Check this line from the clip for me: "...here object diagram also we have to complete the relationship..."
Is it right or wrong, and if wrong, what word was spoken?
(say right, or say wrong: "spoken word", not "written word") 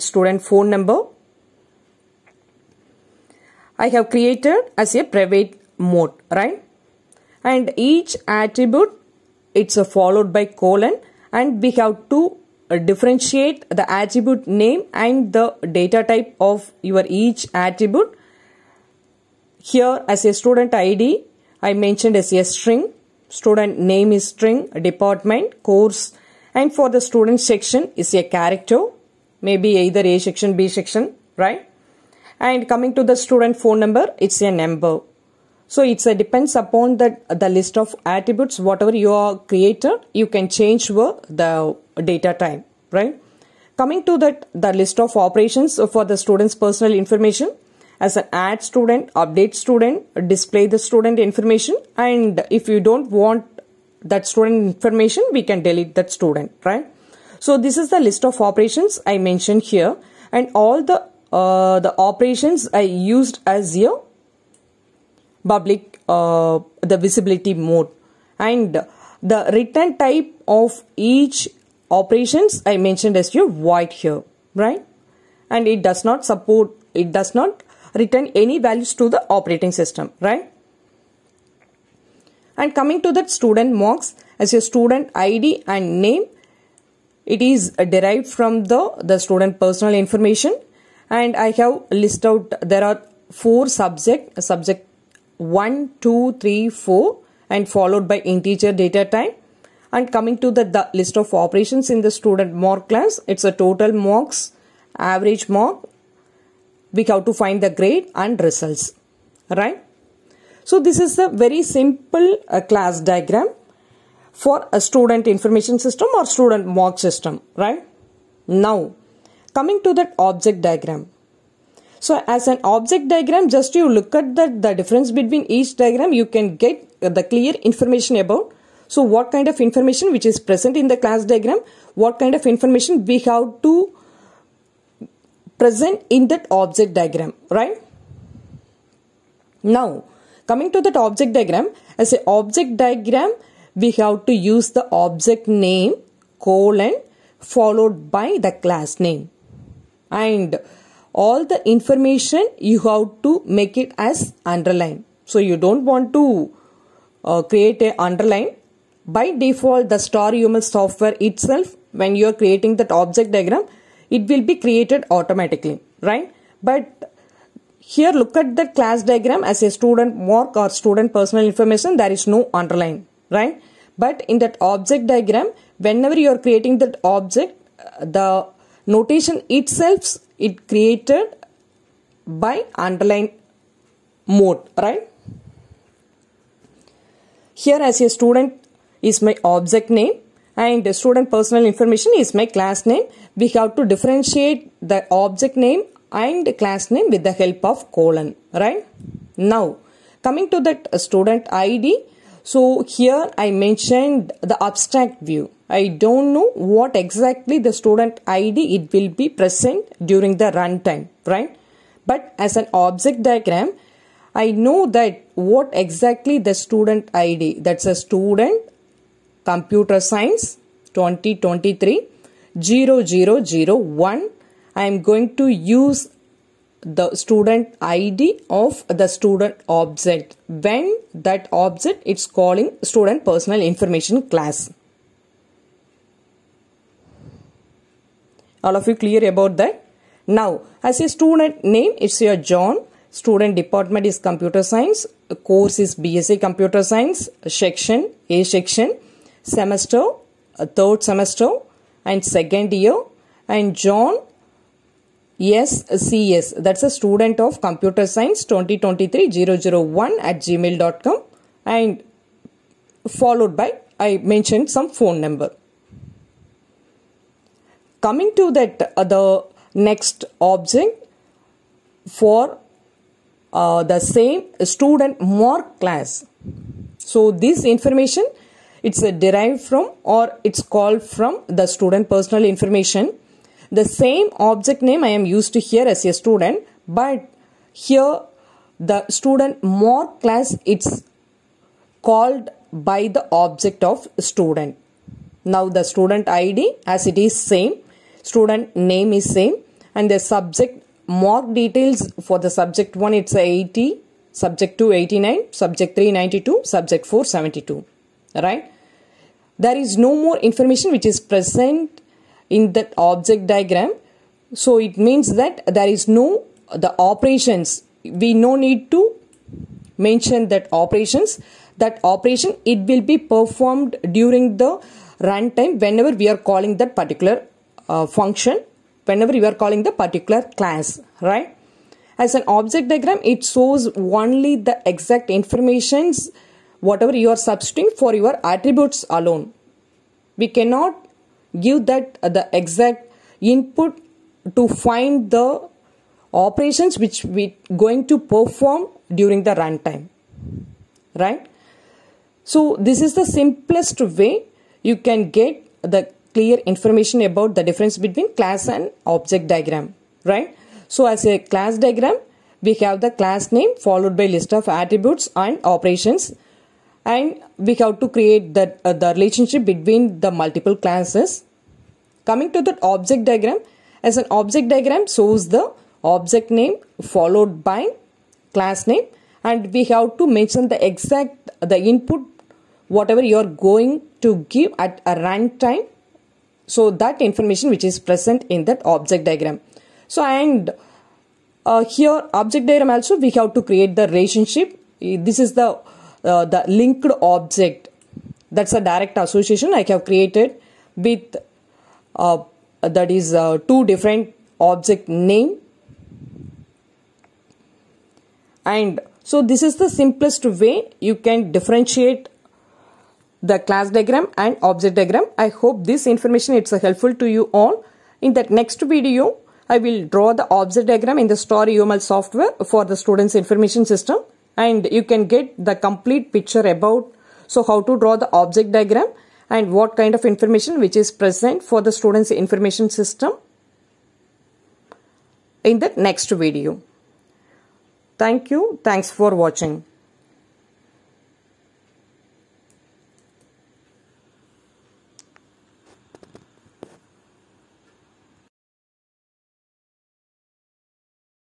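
wrong: "create", not "complete".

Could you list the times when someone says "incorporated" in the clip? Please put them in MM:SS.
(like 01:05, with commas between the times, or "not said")
not said.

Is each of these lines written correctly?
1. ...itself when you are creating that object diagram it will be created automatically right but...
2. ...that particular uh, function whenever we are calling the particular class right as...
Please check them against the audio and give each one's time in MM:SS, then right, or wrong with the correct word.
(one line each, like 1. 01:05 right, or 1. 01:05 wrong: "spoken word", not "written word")
1. 02:41 right
2. 05:26 right.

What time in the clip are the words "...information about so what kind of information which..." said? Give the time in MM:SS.
02:07.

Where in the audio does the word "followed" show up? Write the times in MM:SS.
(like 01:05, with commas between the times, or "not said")
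00:09, 01:37, 02:27, 04:23, 06:03, 06:17.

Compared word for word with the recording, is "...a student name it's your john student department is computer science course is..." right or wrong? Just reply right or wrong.
right.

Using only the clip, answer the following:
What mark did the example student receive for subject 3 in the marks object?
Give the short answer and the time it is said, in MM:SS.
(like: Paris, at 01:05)
92, at 05:06.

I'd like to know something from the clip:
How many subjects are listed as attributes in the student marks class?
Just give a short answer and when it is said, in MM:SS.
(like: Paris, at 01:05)
4, at 01:33.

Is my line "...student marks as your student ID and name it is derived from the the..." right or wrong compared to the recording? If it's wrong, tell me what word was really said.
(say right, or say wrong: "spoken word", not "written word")
right.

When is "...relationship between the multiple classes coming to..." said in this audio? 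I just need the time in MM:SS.
06:09.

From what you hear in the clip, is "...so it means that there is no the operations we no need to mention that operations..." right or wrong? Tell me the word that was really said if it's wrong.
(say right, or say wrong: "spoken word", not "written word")
right.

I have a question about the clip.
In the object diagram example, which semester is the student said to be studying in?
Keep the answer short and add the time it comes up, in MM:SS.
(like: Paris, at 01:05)
third semester, at 04:10.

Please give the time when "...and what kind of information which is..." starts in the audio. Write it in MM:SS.
07:09.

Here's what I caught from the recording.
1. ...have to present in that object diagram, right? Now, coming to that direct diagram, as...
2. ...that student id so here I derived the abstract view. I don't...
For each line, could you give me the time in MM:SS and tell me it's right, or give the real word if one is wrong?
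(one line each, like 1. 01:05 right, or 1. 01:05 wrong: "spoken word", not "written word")
1. 02:13 wrong: "object", not "direct"
2. 03:20 wrong: "mentioned", not "derived".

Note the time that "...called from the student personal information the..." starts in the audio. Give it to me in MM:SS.
04:40.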